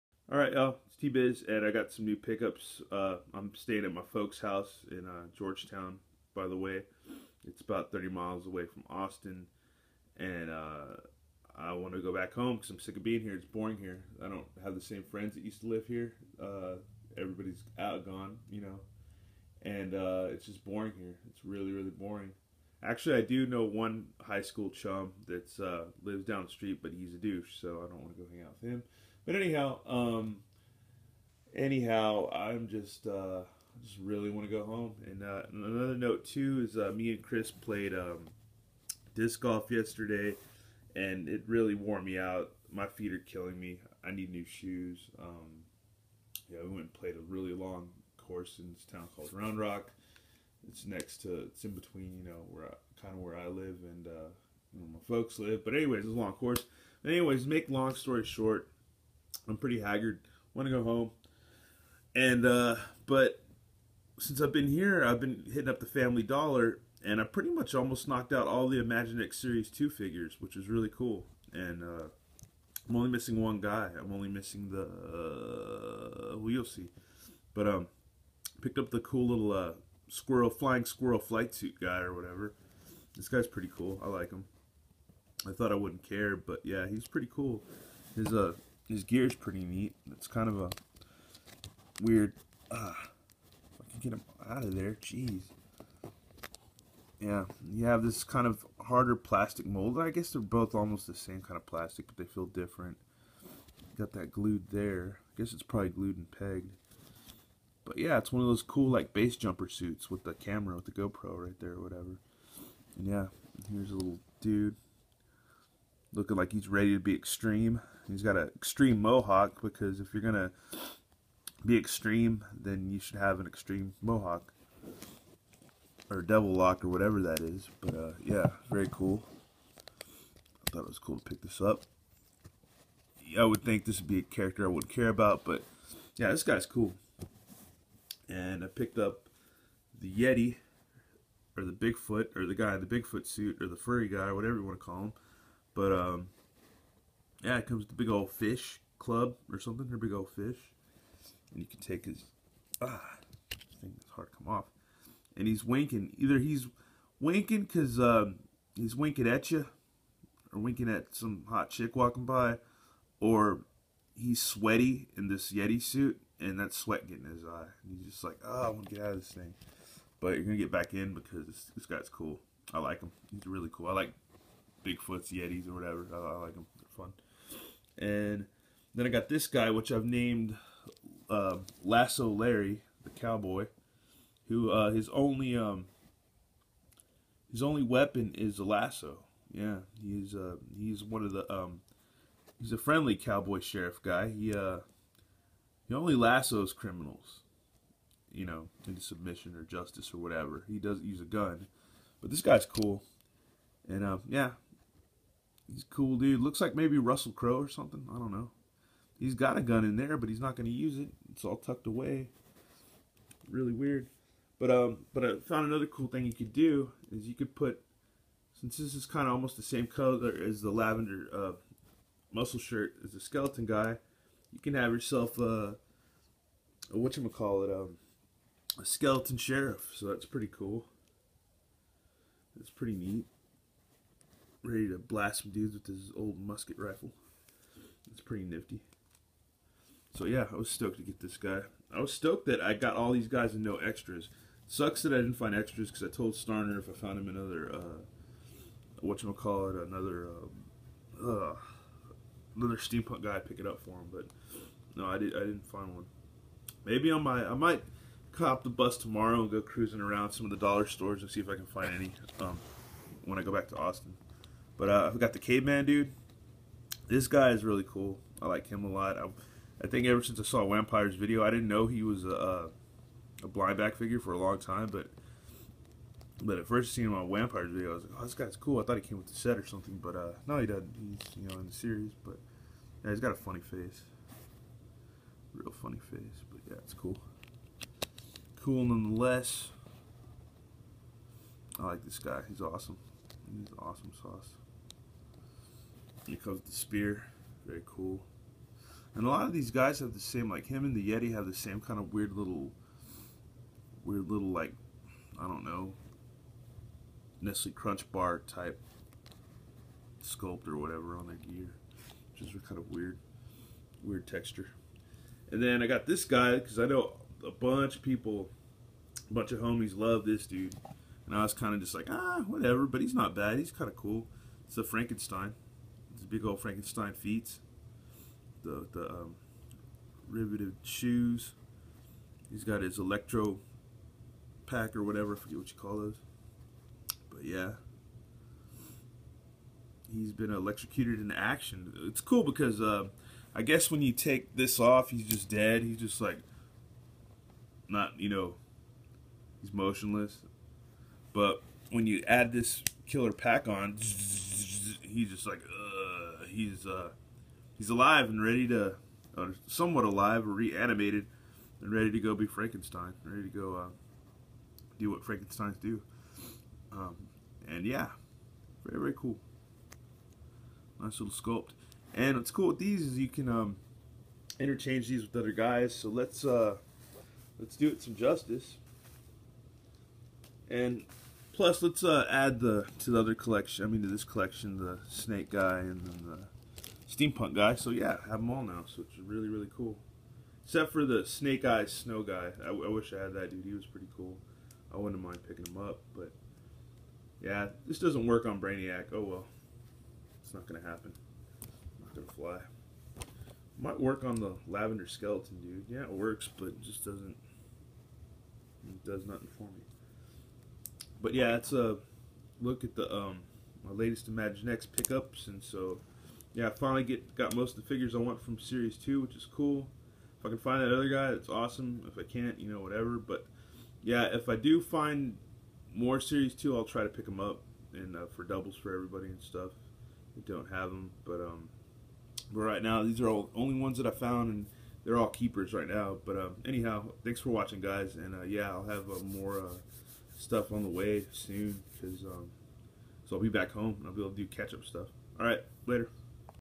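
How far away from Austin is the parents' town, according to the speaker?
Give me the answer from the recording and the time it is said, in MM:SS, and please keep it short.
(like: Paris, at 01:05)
30 miles, at 00:07.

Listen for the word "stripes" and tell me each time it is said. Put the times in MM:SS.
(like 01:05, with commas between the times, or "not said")
not said.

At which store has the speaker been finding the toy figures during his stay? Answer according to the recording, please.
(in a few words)
Family Dollar.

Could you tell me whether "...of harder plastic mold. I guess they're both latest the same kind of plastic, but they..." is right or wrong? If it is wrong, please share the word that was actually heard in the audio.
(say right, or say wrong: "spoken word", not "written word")
wrong: "almost", not "latest".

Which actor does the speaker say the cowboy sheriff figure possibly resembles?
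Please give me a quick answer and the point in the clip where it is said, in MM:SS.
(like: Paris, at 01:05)
Russell Crowe, at 03:26.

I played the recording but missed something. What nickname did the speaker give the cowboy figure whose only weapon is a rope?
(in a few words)
Lasso Larry.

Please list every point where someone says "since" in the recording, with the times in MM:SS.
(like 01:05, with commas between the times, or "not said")
01:04, 03:38, 04:30.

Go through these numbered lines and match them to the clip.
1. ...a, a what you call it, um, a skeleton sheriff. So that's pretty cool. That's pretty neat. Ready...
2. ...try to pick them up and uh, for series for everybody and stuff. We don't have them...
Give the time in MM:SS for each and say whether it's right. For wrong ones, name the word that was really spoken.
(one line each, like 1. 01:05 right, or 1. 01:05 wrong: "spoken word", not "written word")
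1. 03:45 right
2. 07:06 wrong: "doubles", not "series".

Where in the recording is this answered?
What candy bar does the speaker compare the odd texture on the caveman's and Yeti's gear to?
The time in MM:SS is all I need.
05:07.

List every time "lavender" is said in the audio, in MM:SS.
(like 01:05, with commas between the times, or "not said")
03:40, 06:44.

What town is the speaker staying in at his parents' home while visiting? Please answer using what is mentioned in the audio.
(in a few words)
Georgetown.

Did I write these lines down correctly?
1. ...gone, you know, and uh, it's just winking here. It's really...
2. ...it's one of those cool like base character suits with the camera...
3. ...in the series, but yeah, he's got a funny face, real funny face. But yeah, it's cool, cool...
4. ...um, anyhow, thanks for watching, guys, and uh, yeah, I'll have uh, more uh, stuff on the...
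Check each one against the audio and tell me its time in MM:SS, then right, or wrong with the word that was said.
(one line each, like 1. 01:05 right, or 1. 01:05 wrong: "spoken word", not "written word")
1. 00:18 wrong: "boring", not "winking"
2. 01:48 wrong: "jumper", not "character"
3. 04:41 right
4. 07:16 right.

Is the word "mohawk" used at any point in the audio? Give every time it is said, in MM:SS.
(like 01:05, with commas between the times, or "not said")
01:59, 02:04.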